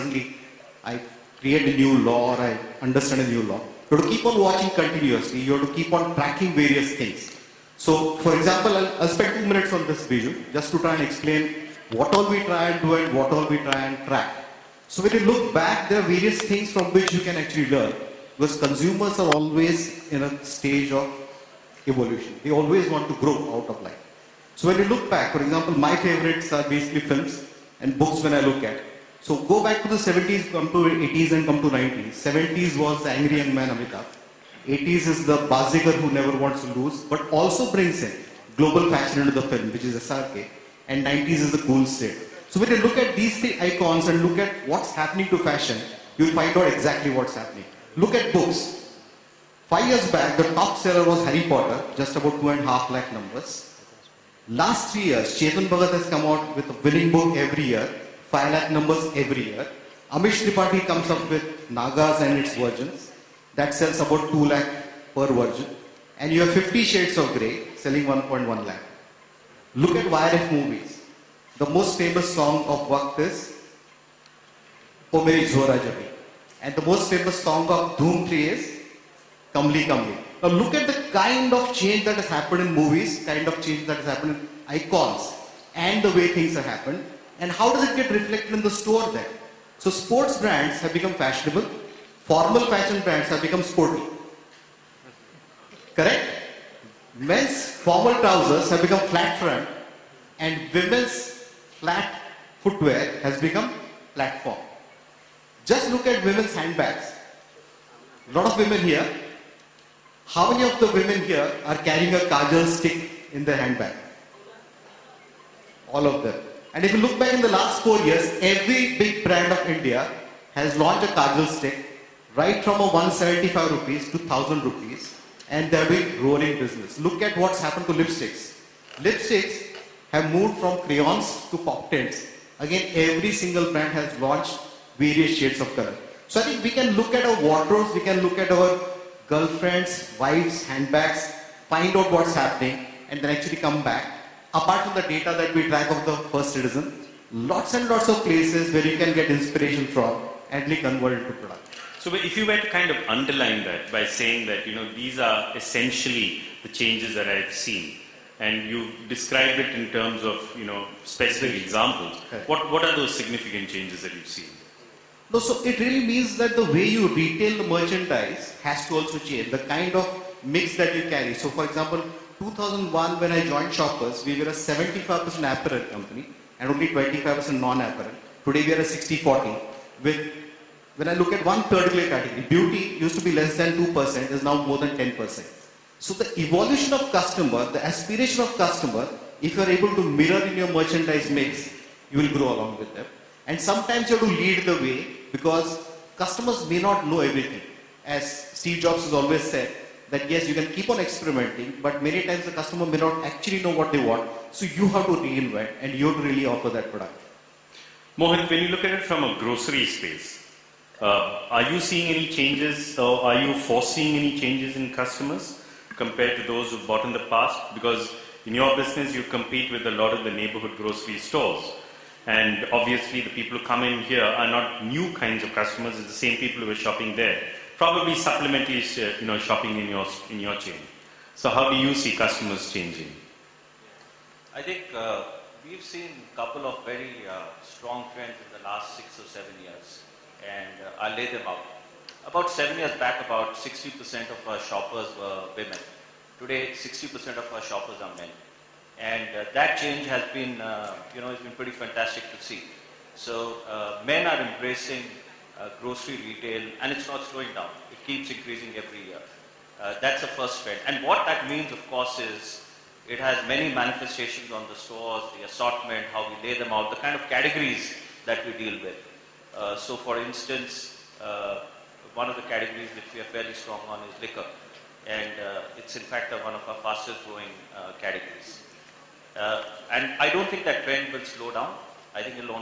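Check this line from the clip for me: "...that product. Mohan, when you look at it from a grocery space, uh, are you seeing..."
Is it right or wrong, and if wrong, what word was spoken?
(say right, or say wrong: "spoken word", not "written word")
right.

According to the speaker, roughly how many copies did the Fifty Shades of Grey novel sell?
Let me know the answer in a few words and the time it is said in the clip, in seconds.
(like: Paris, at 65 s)
1.1 lakh, at 68 s.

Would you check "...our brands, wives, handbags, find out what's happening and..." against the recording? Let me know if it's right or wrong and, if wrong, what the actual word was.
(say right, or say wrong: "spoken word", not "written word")
wrong: "girlfriends", not "brands".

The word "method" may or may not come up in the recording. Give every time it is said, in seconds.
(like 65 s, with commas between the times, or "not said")
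not said.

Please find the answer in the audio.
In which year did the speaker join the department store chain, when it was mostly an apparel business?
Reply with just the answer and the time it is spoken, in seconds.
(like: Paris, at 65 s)
2001, at 172 s.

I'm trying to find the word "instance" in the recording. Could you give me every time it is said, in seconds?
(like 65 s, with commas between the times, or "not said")
270 s.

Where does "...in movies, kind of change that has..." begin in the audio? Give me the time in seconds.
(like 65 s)
82 s.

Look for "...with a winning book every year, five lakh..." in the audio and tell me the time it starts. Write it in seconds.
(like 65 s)
56 s.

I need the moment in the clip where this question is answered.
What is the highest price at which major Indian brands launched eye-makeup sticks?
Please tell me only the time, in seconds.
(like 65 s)
124 s.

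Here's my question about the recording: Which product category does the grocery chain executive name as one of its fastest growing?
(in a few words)
liquor.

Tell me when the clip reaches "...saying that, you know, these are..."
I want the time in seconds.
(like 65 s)
154 s.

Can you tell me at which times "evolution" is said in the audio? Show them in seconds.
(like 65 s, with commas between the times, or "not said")
21 s, 186 s.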